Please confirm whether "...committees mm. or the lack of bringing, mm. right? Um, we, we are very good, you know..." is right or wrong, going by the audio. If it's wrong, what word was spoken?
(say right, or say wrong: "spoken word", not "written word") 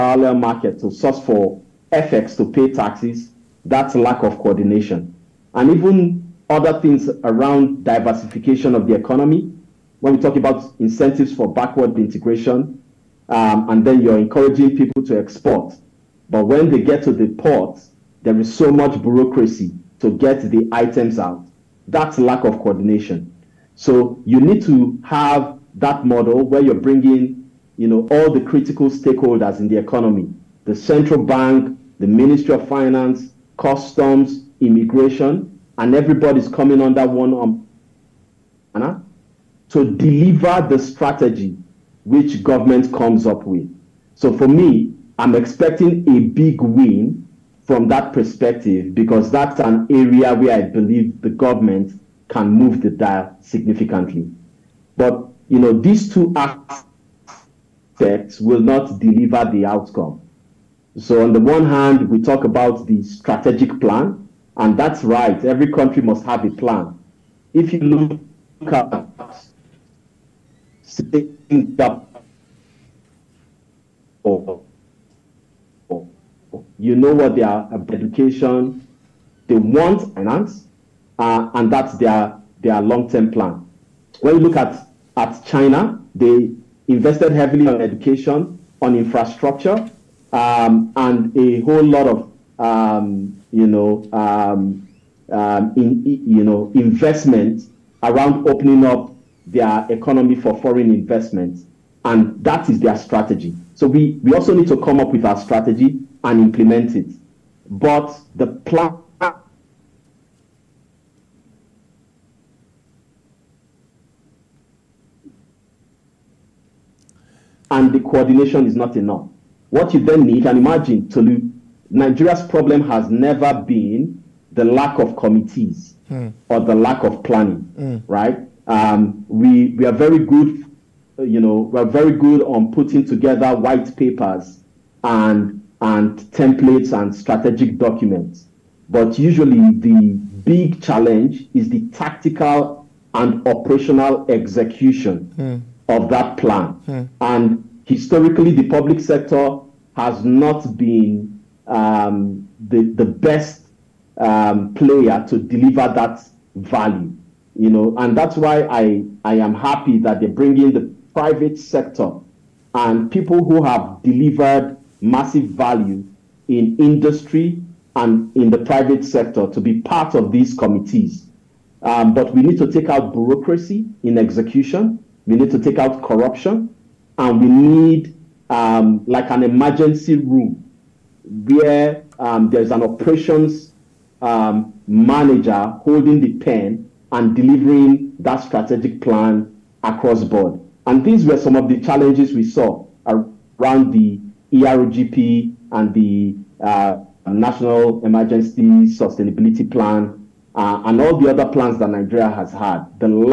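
wrong: "planning", not "bringing".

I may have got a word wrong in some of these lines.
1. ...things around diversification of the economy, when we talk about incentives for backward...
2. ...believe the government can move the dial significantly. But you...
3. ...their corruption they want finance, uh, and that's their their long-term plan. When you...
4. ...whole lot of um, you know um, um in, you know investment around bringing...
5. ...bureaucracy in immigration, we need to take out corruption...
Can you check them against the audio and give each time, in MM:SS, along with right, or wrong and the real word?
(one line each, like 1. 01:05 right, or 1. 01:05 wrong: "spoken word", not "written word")
1. 00:06 right
2. 00:50 right
3. 01:17 wrong: "education", not "corruption"
4. 01:31 wrong: "opening", not "bringing"
5. 02:53 wrong: "execution", not "immigration".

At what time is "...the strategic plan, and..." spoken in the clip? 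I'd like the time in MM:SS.
01:02.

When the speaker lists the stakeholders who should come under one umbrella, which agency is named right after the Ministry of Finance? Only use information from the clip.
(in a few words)
customs.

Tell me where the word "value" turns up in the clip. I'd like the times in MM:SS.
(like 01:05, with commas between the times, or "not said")
02:36, 02:45.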